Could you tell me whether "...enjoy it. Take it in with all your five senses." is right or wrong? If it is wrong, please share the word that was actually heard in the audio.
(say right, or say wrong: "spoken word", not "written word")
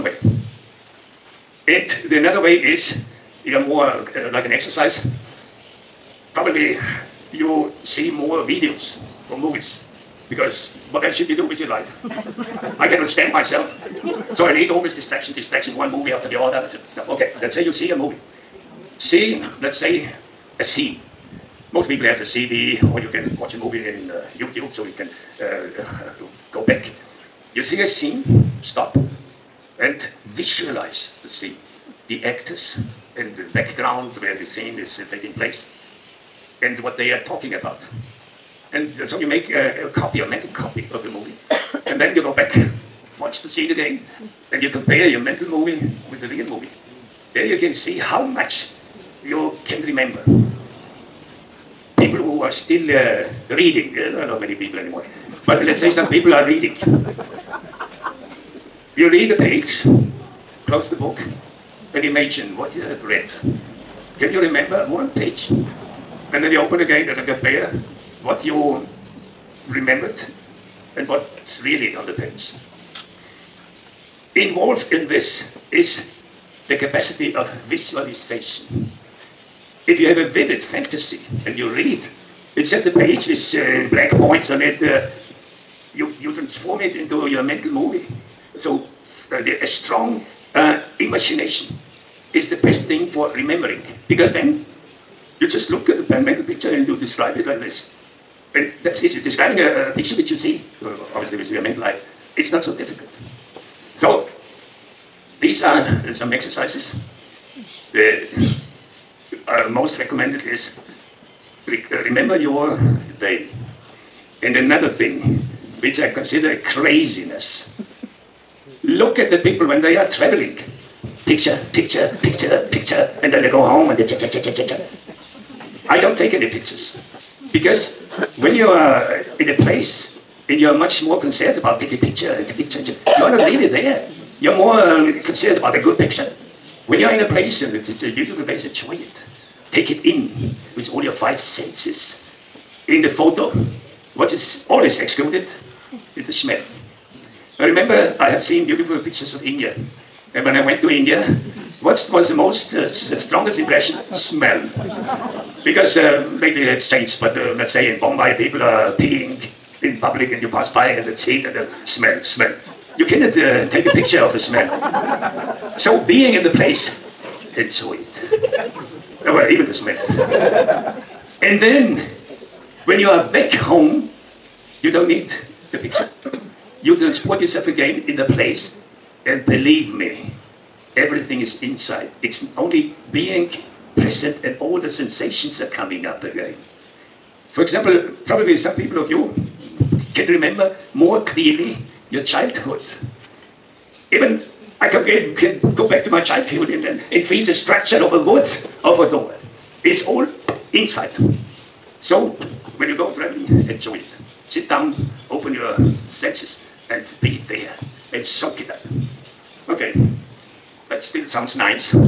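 right.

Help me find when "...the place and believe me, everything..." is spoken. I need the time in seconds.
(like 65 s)
178 s.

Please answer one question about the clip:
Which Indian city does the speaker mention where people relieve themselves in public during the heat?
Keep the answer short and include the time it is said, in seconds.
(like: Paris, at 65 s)
Bombay, at 157 s.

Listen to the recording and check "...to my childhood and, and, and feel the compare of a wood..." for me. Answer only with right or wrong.
wrong.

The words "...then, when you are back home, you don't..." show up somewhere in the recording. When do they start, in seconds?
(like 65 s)
171 s.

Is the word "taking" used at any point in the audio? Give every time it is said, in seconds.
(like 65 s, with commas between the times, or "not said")
35 s, 131 s.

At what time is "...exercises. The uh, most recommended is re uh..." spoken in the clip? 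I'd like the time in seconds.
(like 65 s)
106 s.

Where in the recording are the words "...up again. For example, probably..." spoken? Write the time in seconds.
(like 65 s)
186 s.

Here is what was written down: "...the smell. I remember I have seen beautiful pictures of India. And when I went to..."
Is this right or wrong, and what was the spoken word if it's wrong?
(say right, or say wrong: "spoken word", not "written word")
right.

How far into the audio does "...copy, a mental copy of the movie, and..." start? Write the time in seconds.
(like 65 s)
39 s.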